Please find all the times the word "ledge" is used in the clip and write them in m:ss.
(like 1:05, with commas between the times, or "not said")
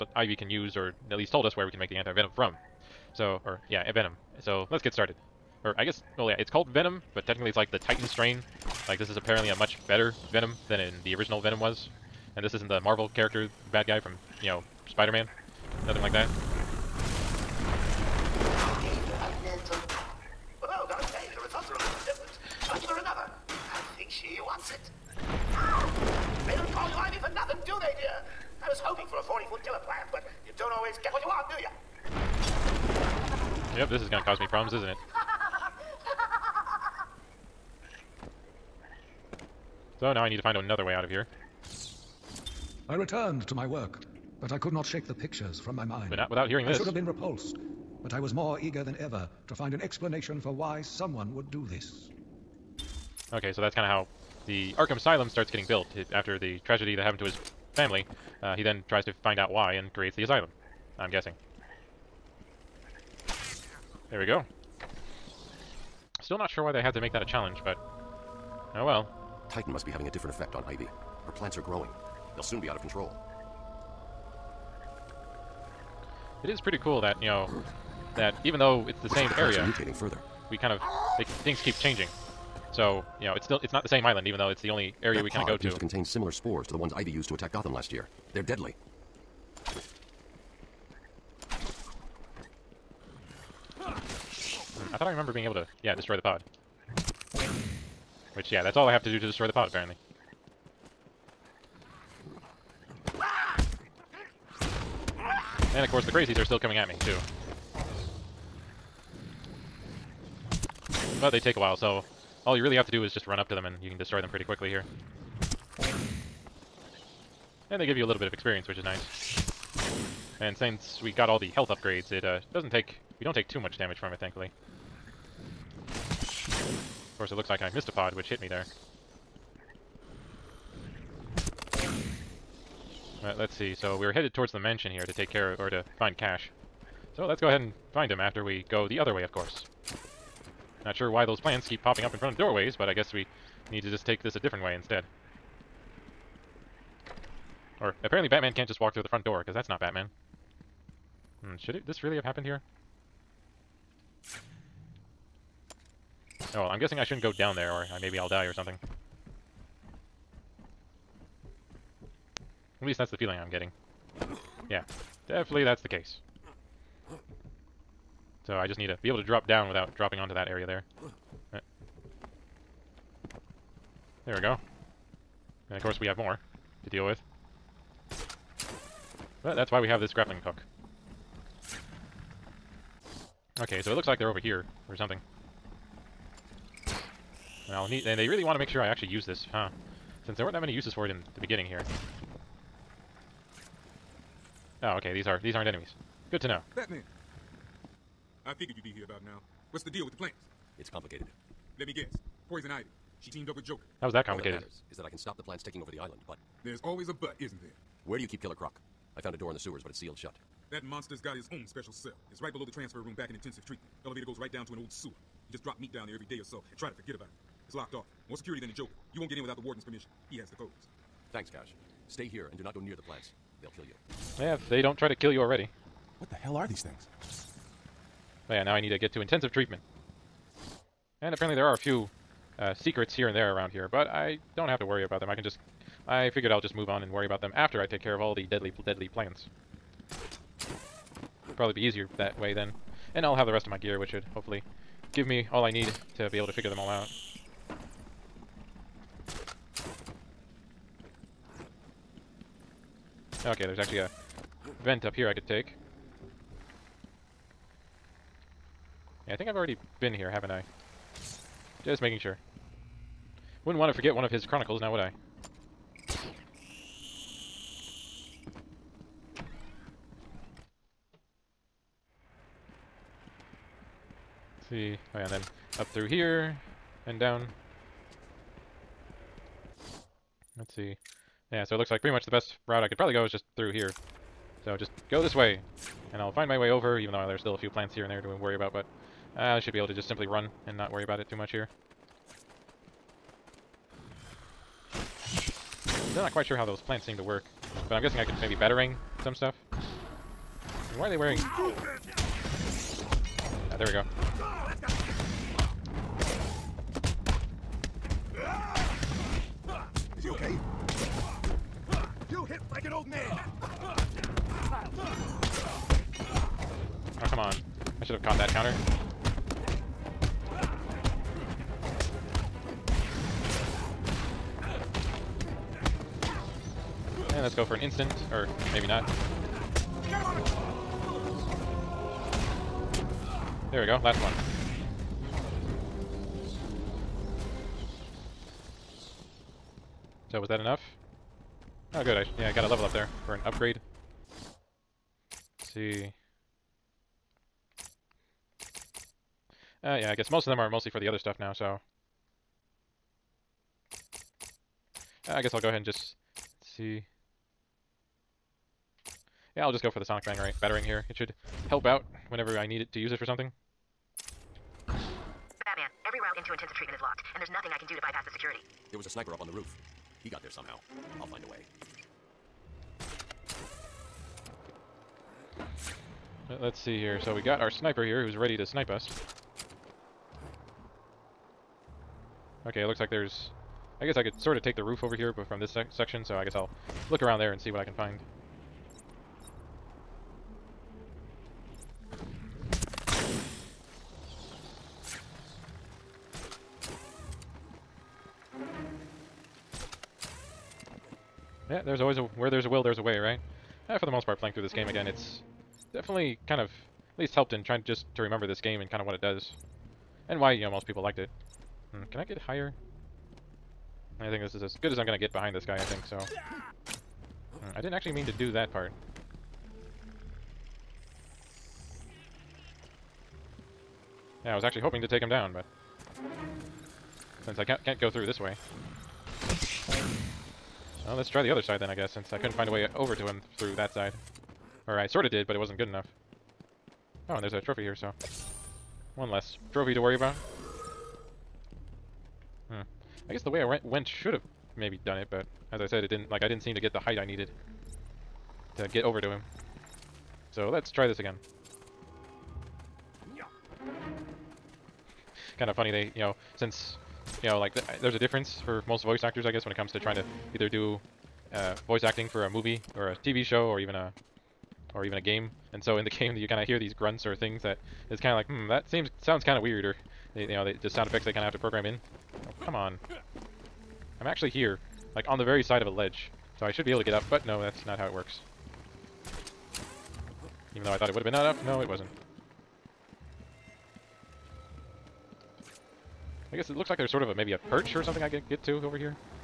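7:55.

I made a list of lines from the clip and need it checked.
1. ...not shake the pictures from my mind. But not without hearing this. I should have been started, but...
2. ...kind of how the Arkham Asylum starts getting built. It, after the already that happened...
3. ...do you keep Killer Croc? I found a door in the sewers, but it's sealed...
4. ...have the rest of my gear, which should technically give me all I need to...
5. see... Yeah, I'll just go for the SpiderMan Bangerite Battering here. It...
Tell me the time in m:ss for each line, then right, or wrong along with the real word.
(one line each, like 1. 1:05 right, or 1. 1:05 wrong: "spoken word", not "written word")
1. 0:44 wrong: "repulsed", not "started"
2. 0:53 wrong: "tragedy", not "already"
3. 3:28 right
4. 4:03 wrong: "hopefully", not "technically"
5. 5:56 wrong: "Sonic", not "SpiderMan".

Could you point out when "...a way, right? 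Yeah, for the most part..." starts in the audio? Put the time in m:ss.
6:42.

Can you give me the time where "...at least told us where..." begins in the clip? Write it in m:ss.
0:01.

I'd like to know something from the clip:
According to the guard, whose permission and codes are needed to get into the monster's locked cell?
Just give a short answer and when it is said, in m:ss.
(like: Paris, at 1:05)
The warden, at 3:39.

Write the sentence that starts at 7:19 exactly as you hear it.
One less trophy to worry about.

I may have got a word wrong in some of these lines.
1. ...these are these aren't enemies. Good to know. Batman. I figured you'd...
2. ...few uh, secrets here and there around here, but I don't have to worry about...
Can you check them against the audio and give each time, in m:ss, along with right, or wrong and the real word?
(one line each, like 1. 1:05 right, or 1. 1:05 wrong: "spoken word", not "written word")
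1. 3:15 right
2. 3:51 right.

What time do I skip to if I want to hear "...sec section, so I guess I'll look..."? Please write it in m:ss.
6:25.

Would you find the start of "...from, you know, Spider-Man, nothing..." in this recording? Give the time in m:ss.
0:13.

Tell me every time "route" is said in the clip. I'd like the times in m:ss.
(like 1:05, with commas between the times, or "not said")
4:42, 6:06.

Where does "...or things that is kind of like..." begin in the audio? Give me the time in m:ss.
7:47.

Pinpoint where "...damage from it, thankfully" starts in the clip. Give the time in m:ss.
2:03.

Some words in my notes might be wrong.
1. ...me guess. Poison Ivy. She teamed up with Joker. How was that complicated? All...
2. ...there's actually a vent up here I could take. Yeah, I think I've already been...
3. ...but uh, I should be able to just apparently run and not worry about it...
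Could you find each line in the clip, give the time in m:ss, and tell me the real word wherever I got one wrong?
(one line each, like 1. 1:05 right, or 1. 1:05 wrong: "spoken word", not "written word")
1. 3:21 right
2. 4:13 right
3. 4:48 wrong: "simply", not "apparently".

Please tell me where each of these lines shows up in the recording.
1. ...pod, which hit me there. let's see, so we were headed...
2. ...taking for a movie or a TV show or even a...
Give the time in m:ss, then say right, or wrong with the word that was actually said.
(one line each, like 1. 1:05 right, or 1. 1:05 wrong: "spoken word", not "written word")
1. 2:07 right
2. 7:42 wrong: "acting", not "taking".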